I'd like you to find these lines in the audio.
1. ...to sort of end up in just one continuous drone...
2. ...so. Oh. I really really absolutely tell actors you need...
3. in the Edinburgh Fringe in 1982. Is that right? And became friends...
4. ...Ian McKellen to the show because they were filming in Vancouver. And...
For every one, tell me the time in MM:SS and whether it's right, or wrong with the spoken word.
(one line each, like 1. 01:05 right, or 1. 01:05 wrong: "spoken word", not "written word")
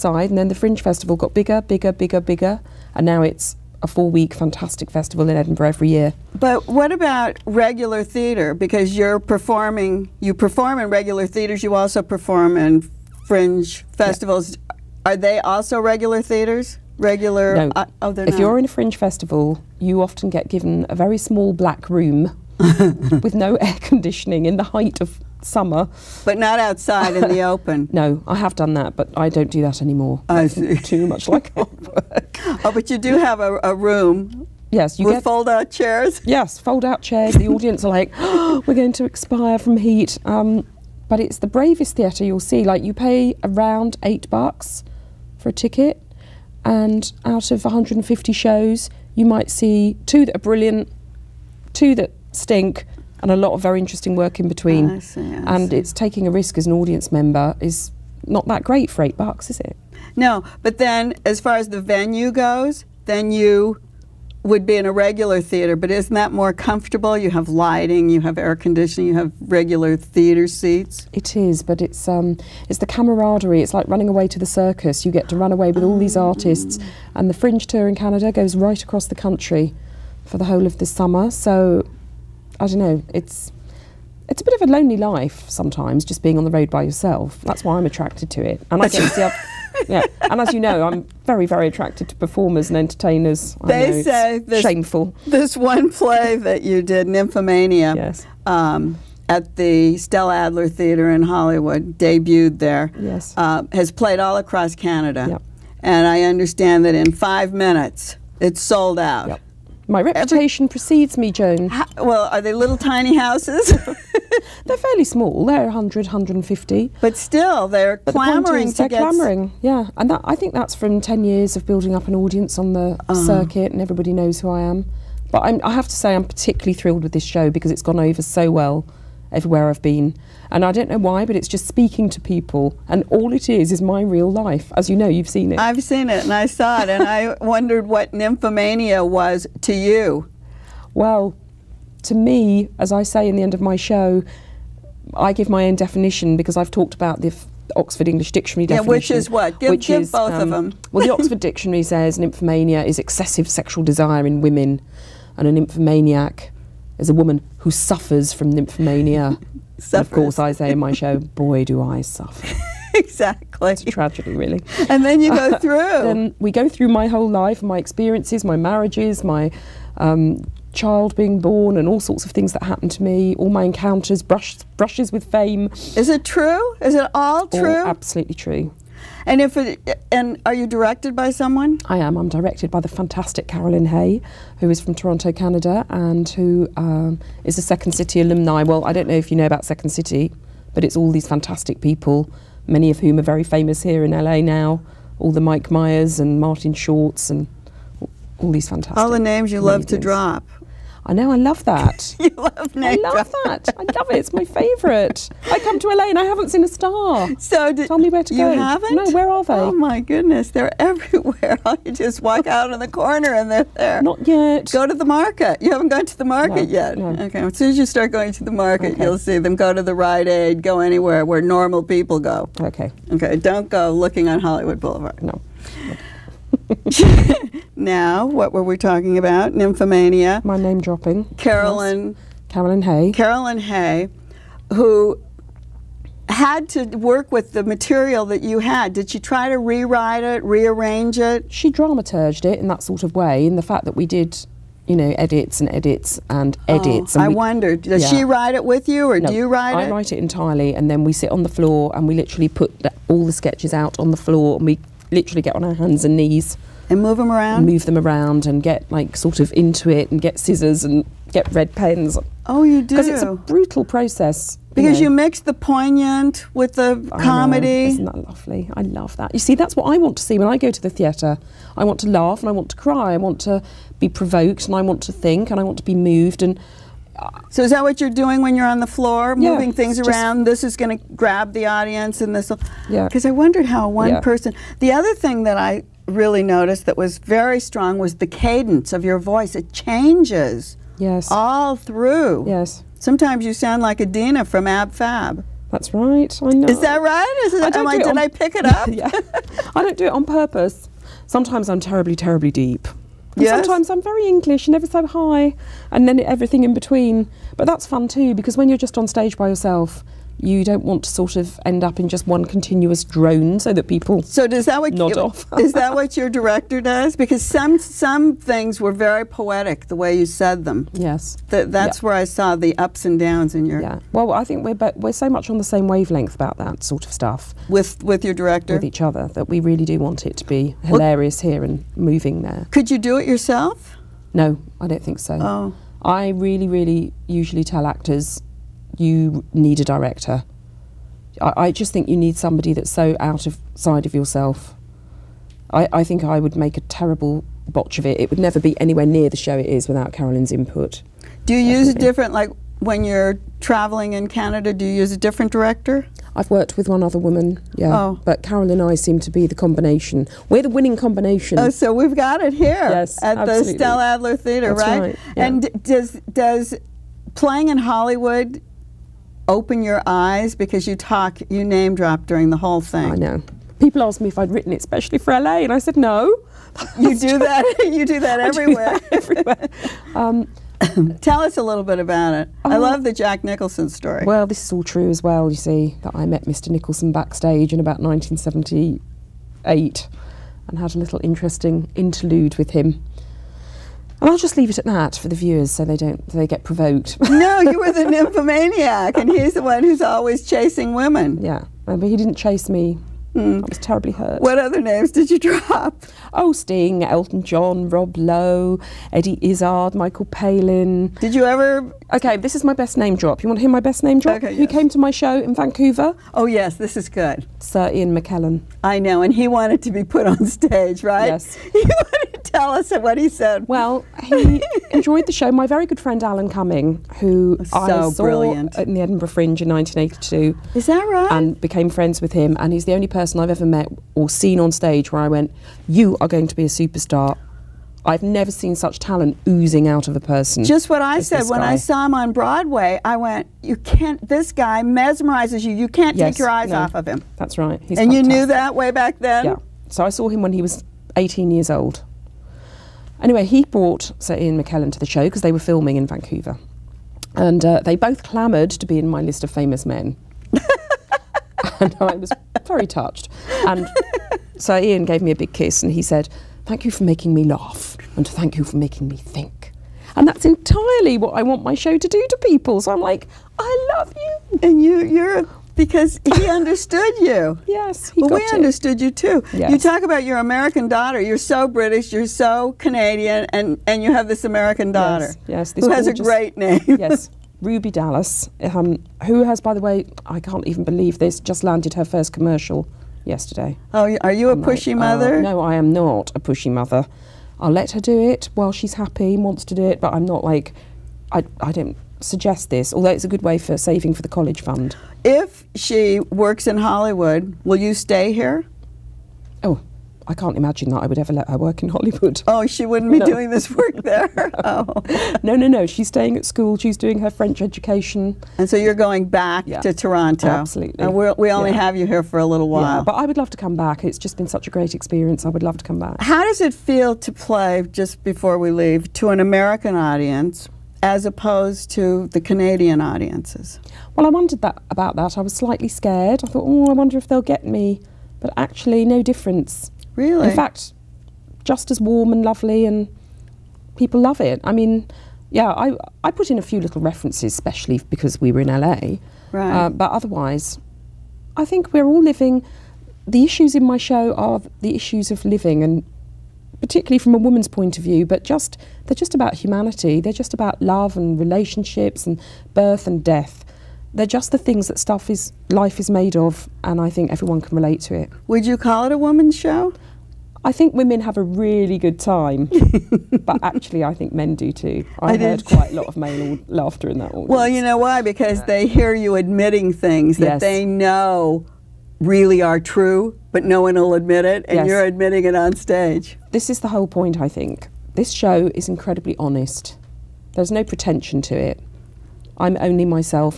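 1. 05:11 right
2. 05:35 wrong: "usually", not "absolutely"
3. 07:08 right
4. 07:34 right.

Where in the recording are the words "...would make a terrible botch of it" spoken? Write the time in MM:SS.
05:46.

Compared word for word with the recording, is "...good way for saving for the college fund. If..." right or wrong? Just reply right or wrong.
right.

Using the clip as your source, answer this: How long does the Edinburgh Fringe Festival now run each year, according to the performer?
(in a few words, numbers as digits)
4 weeks.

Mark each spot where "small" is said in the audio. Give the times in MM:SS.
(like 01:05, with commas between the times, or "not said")
00:21, 01:55.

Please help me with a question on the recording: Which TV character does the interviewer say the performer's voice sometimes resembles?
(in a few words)
Edina.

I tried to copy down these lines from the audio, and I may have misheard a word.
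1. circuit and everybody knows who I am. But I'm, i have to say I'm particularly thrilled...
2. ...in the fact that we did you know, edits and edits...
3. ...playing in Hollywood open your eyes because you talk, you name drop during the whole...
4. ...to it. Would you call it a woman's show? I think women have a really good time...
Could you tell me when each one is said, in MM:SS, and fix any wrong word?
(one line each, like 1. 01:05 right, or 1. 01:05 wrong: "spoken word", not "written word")
1. 02:03 right
2. 04:03 right
3. 06:07 right
4. 09:28 right.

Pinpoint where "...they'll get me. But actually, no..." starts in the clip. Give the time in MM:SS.
08:57.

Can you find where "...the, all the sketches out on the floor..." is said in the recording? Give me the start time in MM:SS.
04:12.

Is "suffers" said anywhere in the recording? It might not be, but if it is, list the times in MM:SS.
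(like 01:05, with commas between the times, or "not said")
02:37, 02:42.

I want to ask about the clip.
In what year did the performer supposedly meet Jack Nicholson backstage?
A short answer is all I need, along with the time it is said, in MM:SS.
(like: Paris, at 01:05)
1978, at 06:27.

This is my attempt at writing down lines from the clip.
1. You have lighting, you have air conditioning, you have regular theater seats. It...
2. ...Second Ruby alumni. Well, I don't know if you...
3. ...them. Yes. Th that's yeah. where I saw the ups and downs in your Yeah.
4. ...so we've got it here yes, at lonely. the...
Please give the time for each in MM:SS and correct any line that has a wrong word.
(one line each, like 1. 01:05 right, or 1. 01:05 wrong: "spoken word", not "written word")
1. 01:07 right
2. 03:07 wrong: "City", not "Ruby"
3. 05:20 right
4. 06:01 wrong: "absolutely", not "lonely".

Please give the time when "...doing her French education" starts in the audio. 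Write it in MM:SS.
08:36.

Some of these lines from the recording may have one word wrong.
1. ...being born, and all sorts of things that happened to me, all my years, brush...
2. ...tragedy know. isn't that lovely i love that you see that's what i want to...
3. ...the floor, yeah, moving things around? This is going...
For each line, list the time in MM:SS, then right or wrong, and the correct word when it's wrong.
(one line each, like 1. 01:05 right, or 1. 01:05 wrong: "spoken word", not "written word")
1. 02:51 wrong: "encounters", not "years"
2. 04:27 wrong: "comedy", not "tragedy"
3. 04:38 right.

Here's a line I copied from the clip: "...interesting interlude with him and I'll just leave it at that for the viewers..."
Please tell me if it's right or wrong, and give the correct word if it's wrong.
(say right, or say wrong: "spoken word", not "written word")
right.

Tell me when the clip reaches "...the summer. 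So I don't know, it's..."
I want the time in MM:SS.
01:20.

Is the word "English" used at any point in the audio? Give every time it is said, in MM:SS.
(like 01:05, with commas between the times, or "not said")
02:28, 05:04.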